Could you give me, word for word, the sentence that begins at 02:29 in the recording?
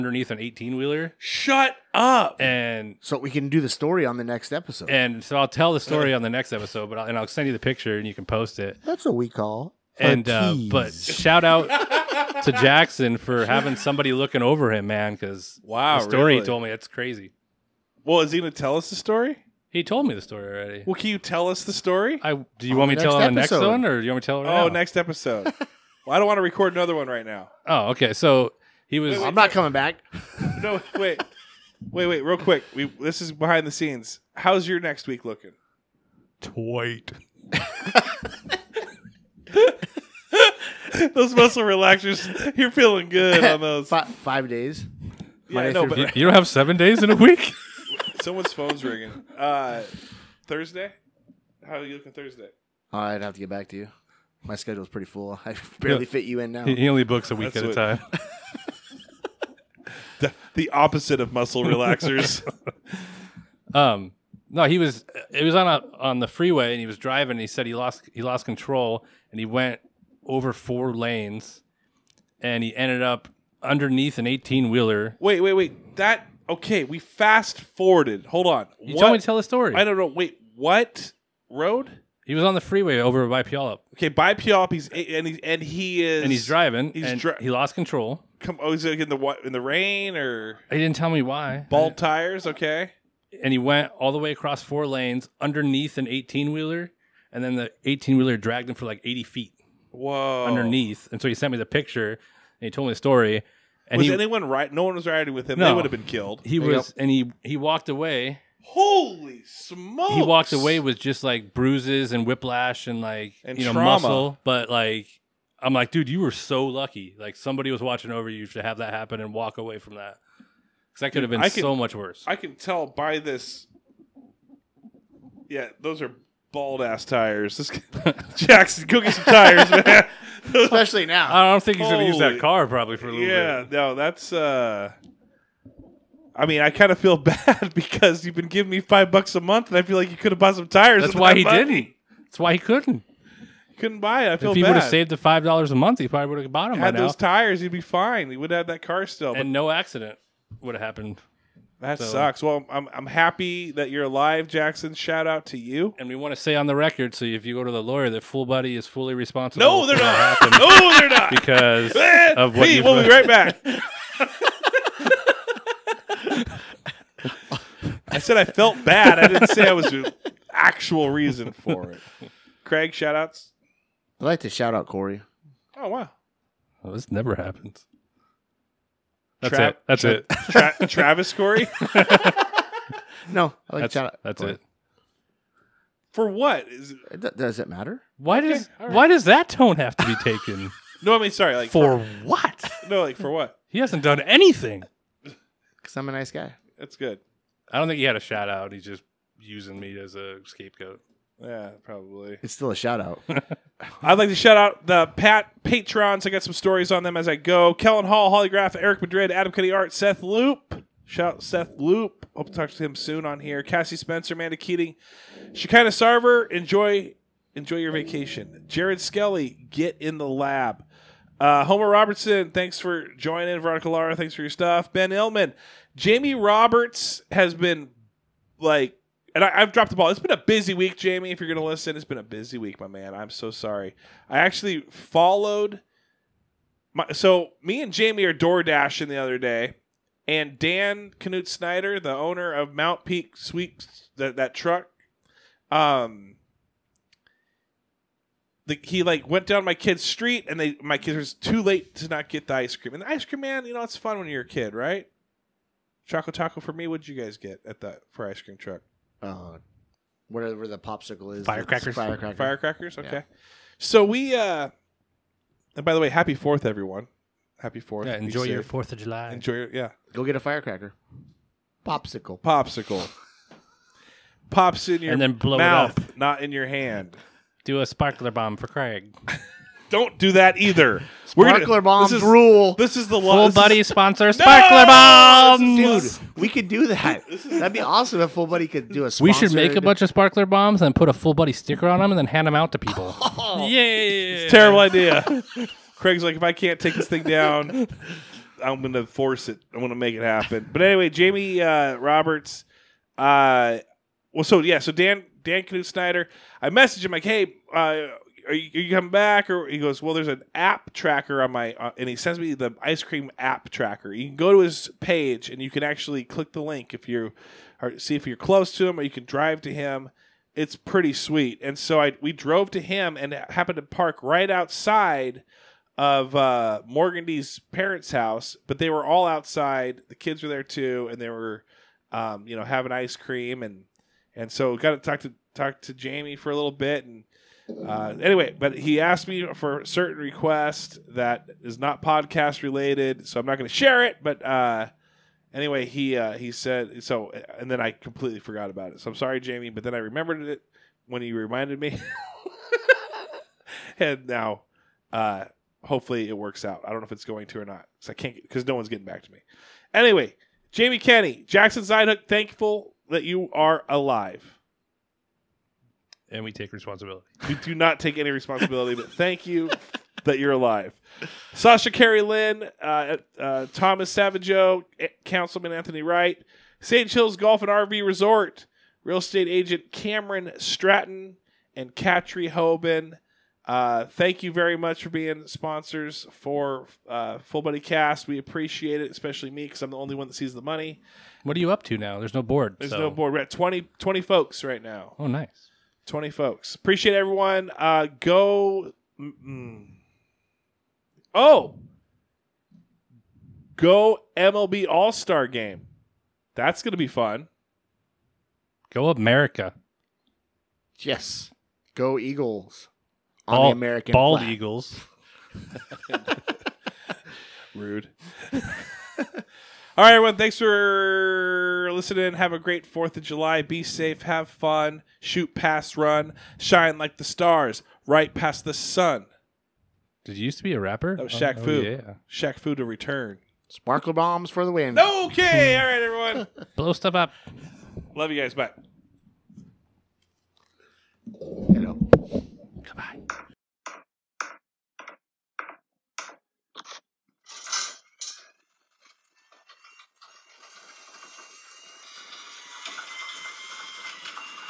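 But and no accident would have happened.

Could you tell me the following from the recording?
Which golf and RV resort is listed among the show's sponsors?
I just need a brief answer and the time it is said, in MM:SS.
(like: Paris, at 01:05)
St. Hills Golf and RV Resort, at 06:16.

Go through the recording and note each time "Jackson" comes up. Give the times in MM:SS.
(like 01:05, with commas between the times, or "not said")
00:12, 02:08, 02:34, 06:01.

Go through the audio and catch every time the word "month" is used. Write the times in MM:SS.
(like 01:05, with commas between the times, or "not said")
02:19, 02:25.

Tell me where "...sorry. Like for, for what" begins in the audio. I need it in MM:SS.
03:11.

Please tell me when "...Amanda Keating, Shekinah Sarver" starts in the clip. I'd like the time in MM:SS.
03:34.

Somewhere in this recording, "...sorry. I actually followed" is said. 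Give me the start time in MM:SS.
03:53.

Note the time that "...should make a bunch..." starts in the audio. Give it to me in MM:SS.
04:49.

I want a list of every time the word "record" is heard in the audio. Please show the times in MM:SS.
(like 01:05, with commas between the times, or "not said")
00:26, 02:36.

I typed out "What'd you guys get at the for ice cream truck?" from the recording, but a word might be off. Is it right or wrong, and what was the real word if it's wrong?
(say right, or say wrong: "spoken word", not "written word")
right.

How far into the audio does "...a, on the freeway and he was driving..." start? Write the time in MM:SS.
01:05.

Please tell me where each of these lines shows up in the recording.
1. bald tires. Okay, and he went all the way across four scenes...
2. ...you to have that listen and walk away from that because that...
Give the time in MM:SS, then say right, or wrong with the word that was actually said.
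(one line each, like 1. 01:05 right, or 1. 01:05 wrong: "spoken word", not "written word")
1. 01:31 wrong: "lanes", not "scenes"
2. 01:58 wrong: "happen", not "listen".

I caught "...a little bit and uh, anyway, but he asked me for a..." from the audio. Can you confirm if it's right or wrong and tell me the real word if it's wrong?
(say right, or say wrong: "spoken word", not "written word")
right.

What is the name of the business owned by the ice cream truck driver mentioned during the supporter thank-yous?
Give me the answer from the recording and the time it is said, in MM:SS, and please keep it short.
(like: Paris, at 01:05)
Mount Peak Sweeps, at 04:02.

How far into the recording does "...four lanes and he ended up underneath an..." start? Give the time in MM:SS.
01:10.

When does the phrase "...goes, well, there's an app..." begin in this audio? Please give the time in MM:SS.
05:09.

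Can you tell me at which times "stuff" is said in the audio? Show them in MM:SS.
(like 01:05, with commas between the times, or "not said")
03:44, 07:16.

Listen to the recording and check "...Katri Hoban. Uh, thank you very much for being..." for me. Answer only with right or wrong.
right.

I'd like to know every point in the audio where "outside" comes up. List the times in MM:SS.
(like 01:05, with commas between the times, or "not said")
05:24, 05:29.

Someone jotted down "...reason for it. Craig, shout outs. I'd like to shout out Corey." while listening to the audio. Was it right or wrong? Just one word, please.
right.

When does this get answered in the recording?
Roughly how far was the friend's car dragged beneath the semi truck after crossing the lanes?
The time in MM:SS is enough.
01:39.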